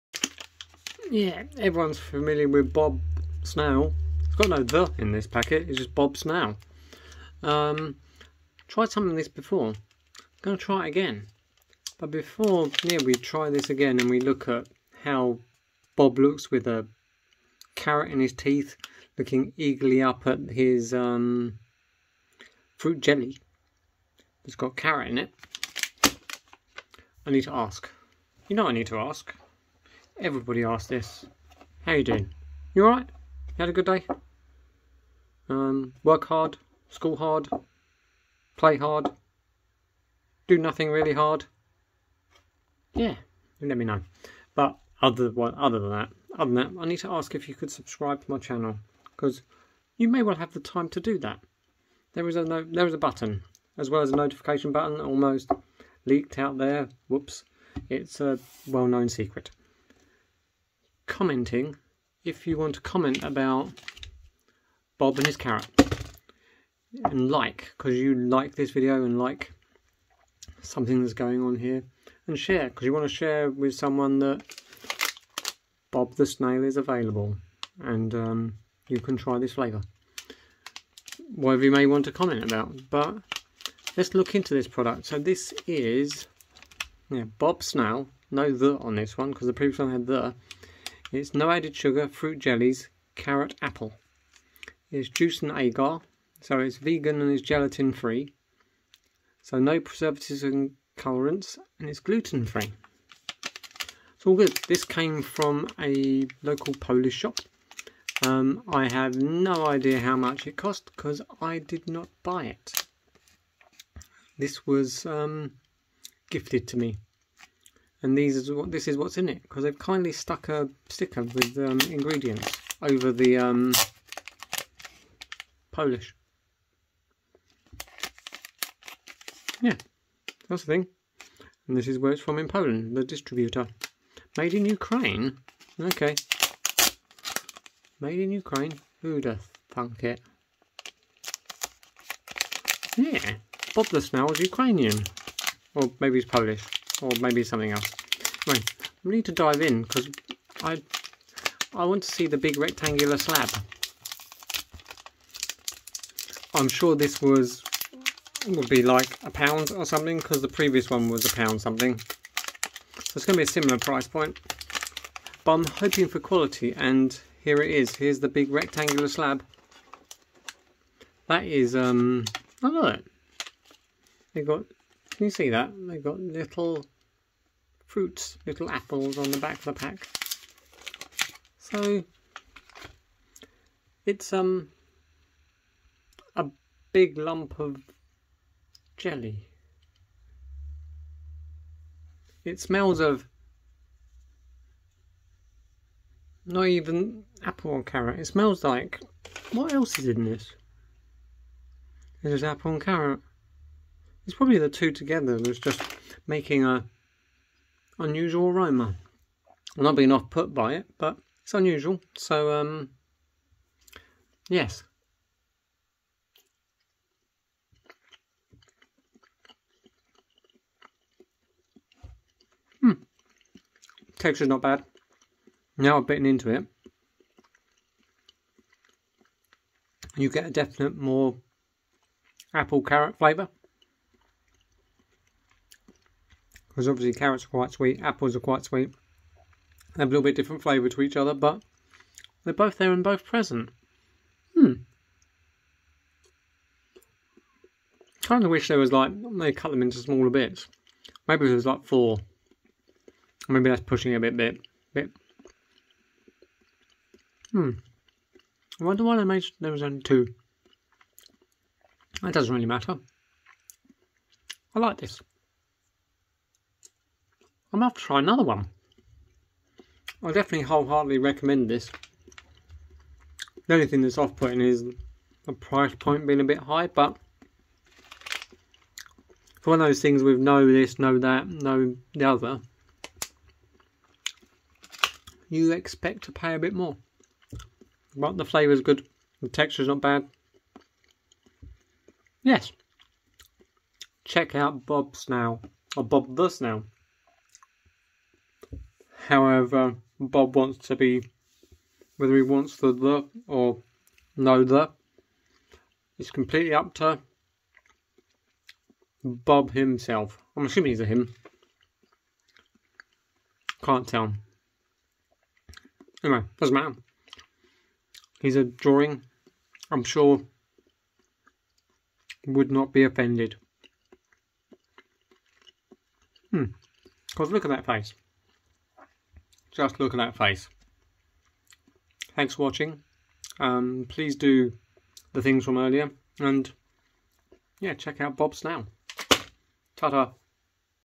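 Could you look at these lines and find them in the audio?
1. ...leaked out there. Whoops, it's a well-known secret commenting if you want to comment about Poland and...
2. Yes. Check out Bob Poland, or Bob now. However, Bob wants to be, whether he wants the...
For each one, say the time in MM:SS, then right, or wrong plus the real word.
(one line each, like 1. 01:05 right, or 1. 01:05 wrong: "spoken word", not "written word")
1. 00:56 wrong: "Bob", not "Poland"
2. 04:52 wrong: "Snail", not "Poland".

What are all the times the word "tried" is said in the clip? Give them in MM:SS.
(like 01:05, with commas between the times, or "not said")
00:08.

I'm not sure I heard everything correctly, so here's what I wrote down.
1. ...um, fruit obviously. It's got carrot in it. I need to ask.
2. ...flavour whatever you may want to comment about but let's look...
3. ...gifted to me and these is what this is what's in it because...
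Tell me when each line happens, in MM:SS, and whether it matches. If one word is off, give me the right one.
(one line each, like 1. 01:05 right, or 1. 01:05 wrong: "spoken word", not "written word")
1. 00:20 wrong: "jelly", not "obviously"
2. 01:19 right
3. 01:56 right.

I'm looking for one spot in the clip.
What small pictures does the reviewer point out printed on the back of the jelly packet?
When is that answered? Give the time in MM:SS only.
02:58.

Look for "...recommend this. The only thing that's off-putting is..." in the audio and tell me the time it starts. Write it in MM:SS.
04:31.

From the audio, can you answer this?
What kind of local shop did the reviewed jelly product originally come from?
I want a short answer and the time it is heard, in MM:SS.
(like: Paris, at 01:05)
Polish shop, at 01:46.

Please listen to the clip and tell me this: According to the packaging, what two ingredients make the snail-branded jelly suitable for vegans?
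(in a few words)
juice and agar.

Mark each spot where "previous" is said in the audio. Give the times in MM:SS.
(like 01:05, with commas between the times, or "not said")
01:29, 02:40.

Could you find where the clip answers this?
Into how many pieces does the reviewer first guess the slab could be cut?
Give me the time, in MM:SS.
04:11.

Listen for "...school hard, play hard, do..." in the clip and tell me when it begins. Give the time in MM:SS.
00:36.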